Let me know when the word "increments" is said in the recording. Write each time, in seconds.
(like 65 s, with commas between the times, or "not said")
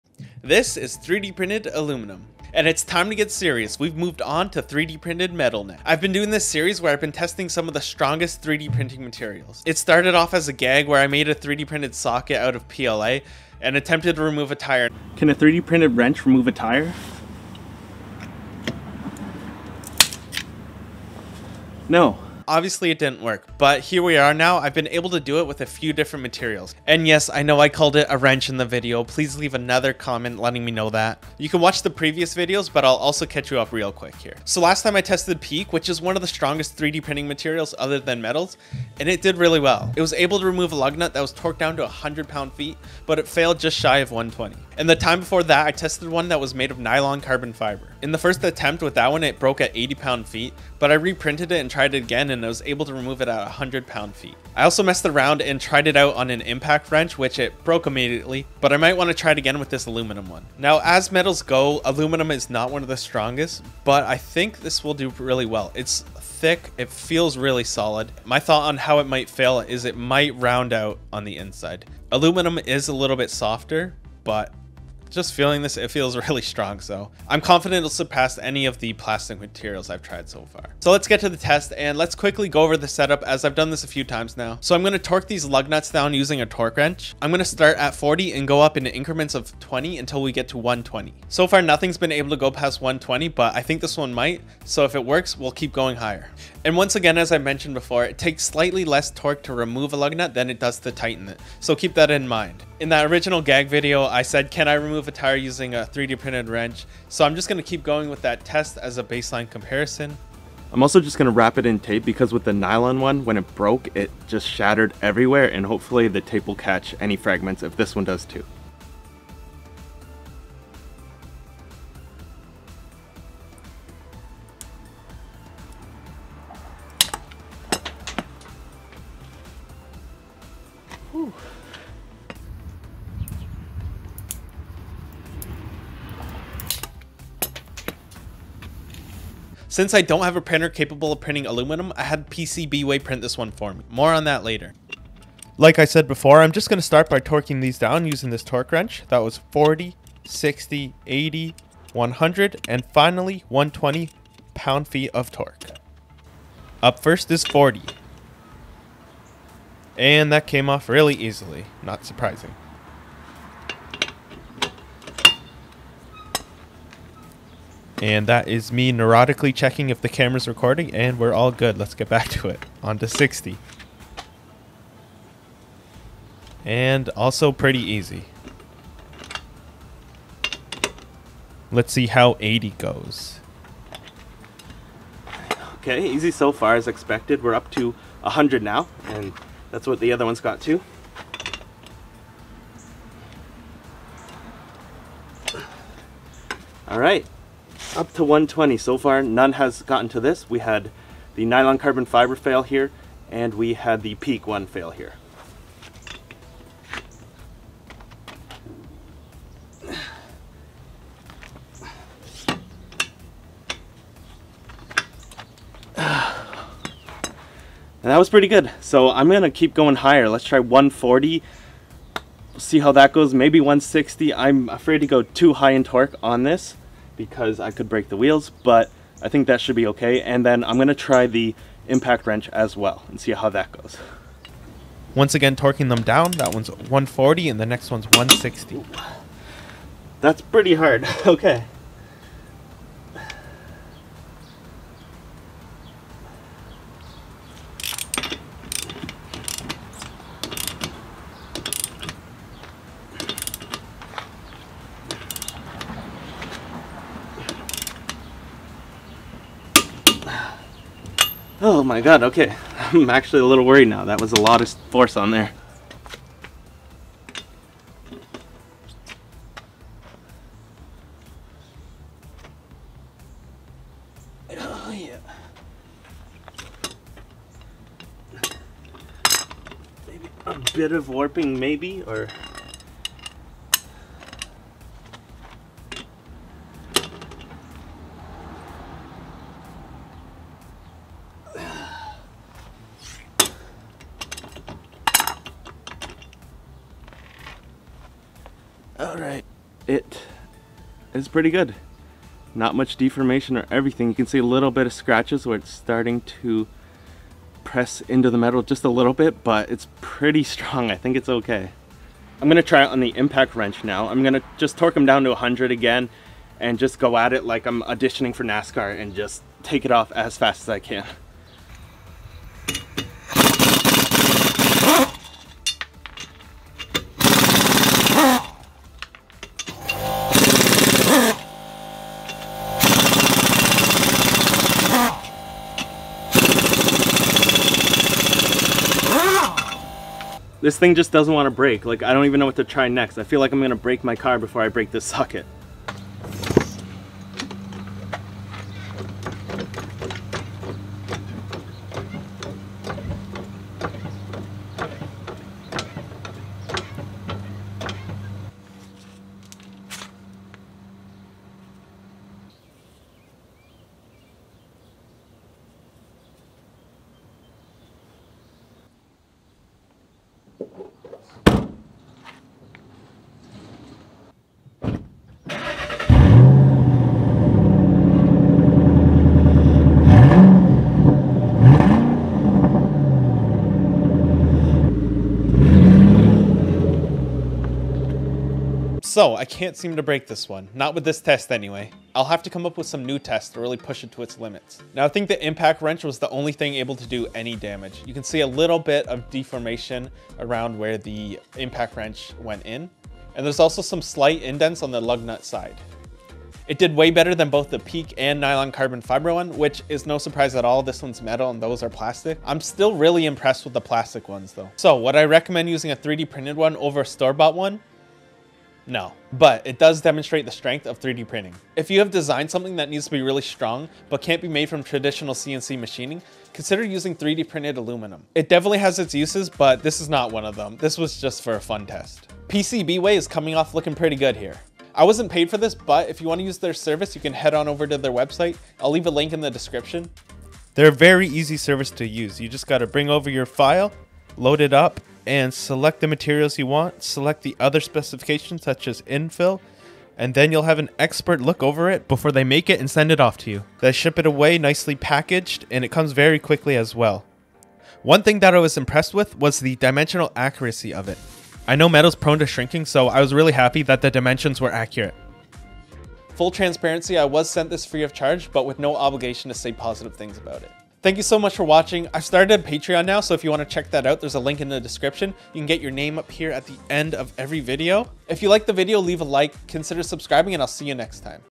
88 s.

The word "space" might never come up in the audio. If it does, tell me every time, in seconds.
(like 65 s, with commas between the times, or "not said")
not said.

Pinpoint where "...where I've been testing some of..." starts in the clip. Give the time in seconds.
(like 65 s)
6 s.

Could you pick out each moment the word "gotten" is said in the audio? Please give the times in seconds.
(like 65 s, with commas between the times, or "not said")
199 s.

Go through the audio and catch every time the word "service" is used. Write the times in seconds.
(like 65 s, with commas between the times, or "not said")
436 s, 441 s.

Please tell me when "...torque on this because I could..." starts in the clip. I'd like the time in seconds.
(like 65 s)
225 s.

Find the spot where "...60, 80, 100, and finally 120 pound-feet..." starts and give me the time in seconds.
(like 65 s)
150 s.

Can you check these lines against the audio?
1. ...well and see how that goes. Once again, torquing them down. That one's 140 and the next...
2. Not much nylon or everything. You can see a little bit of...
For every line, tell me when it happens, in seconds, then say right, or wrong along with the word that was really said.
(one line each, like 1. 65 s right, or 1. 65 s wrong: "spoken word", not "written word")
1. 232 s right
2. 302 s wrong: "deformation", not "nylon".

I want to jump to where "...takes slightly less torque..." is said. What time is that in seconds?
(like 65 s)
98 s.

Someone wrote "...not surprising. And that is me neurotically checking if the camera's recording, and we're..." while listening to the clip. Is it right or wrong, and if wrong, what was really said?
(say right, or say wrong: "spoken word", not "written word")
right.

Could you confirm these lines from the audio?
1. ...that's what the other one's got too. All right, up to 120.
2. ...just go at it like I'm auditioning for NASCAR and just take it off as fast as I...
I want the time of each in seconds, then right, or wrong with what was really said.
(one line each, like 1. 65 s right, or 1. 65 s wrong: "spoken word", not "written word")
1. 189 s right
2. 316 s right.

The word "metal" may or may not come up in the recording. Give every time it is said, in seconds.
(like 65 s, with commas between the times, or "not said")
5 s, 38 s, 61 s, 308 s, 411 s, 461 s.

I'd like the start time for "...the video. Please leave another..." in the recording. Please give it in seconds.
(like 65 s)
28 s.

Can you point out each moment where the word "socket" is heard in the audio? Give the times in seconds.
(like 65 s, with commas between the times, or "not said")
11 s, 345 s.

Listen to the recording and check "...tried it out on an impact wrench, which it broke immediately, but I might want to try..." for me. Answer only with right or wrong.
right.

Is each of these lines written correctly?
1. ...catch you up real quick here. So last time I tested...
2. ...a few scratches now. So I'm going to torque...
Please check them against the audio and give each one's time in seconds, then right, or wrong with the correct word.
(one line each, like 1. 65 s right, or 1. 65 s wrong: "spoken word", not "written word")
1. 33 s right
2. 83 s wrong: "times", not "scratches".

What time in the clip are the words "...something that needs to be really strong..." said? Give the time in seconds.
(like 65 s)
422 s.